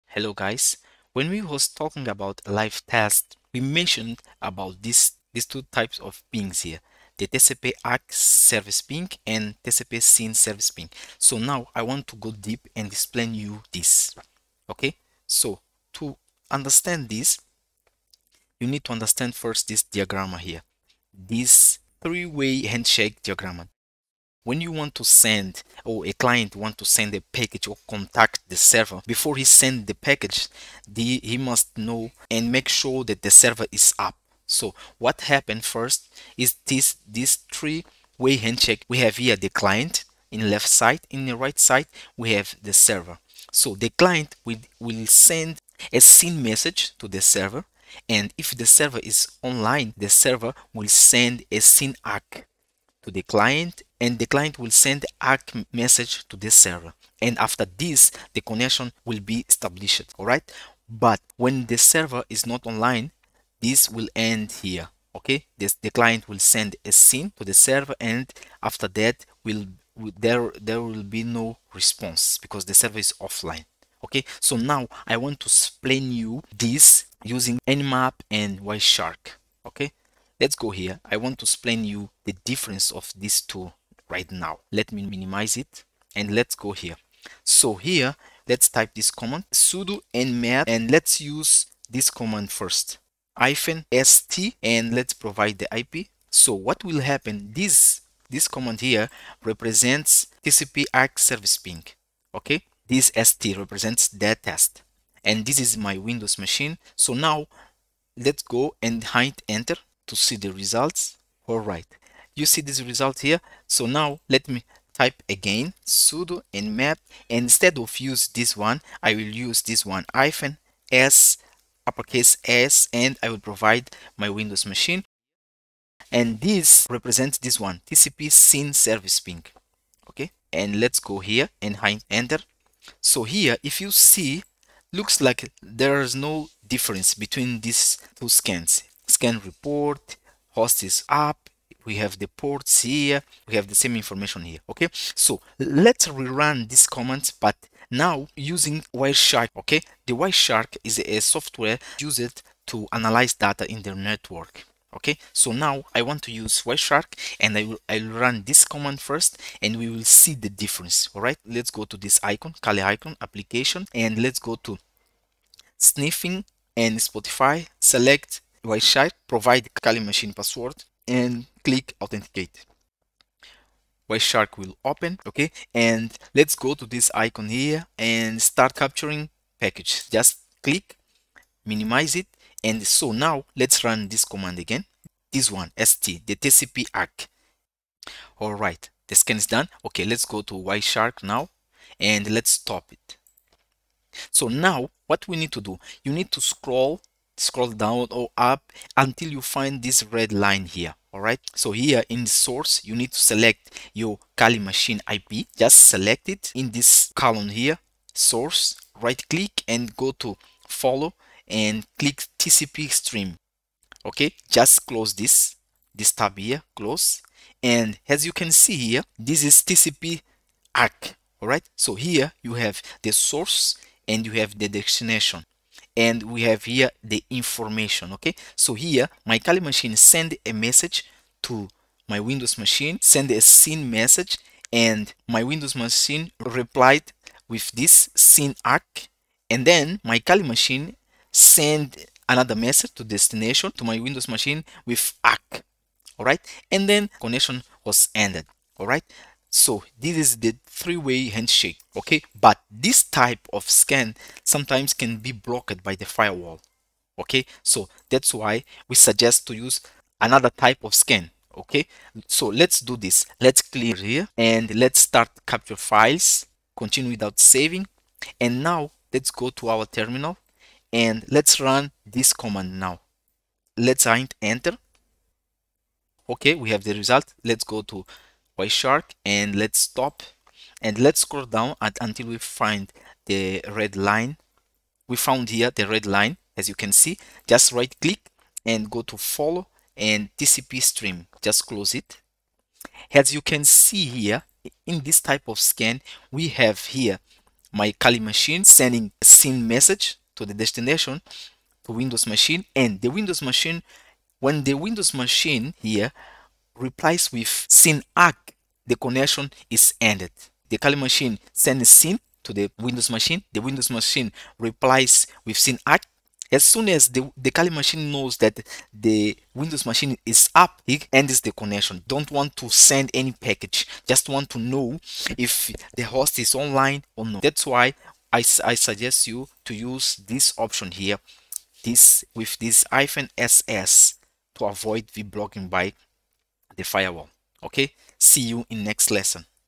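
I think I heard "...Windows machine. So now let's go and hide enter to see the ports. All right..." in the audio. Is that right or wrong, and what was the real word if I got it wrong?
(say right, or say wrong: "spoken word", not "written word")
wrong: "results", not "ports".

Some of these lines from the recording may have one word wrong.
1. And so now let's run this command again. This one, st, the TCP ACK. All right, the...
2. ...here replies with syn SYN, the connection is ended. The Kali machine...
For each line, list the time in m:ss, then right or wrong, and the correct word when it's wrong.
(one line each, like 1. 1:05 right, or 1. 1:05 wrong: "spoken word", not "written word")
1. 3:02 right
2. 5:05 wrong: "ACK", not "SYN".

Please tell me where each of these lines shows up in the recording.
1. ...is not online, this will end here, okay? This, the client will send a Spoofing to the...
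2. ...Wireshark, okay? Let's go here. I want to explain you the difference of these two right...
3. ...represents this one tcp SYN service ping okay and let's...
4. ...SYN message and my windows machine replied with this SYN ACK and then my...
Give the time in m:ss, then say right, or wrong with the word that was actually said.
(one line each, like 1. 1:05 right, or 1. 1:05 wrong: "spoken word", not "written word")
1. 1:02 wrong: "SYN", not "Spoofing"
2. 1:18 right
3. 2:06 right
4. 3:53 right.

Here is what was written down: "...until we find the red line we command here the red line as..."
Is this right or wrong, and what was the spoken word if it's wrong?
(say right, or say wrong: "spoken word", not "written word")
wrong: "found", not "command".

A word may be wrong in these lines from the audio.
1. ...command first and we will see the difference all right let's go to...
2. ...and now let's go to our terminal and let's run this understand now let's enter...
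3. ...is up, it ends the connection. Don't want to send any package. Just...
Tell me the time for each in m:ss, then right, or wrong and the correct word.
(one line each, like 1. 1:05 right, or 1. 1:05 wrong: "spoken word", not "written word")
1. 2:38 right
2. 4:28 wrong: "command", not "understand"
3. 5:20 right.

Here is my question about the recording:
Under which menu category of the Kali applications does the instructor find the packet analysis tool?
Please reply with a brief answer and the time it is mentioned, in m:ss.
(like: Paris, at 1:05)
Sniffing and Spoofing, at 2:45.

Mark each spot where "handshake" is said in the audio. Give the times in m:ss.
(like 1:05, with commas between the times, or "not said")
0:22, 0:38, 4:11.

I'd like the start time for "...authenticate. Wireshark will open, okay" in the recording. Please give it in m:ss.
2:52.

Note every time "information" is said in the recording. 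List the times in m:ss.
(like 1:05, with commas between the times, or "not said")
2:23, 3:47.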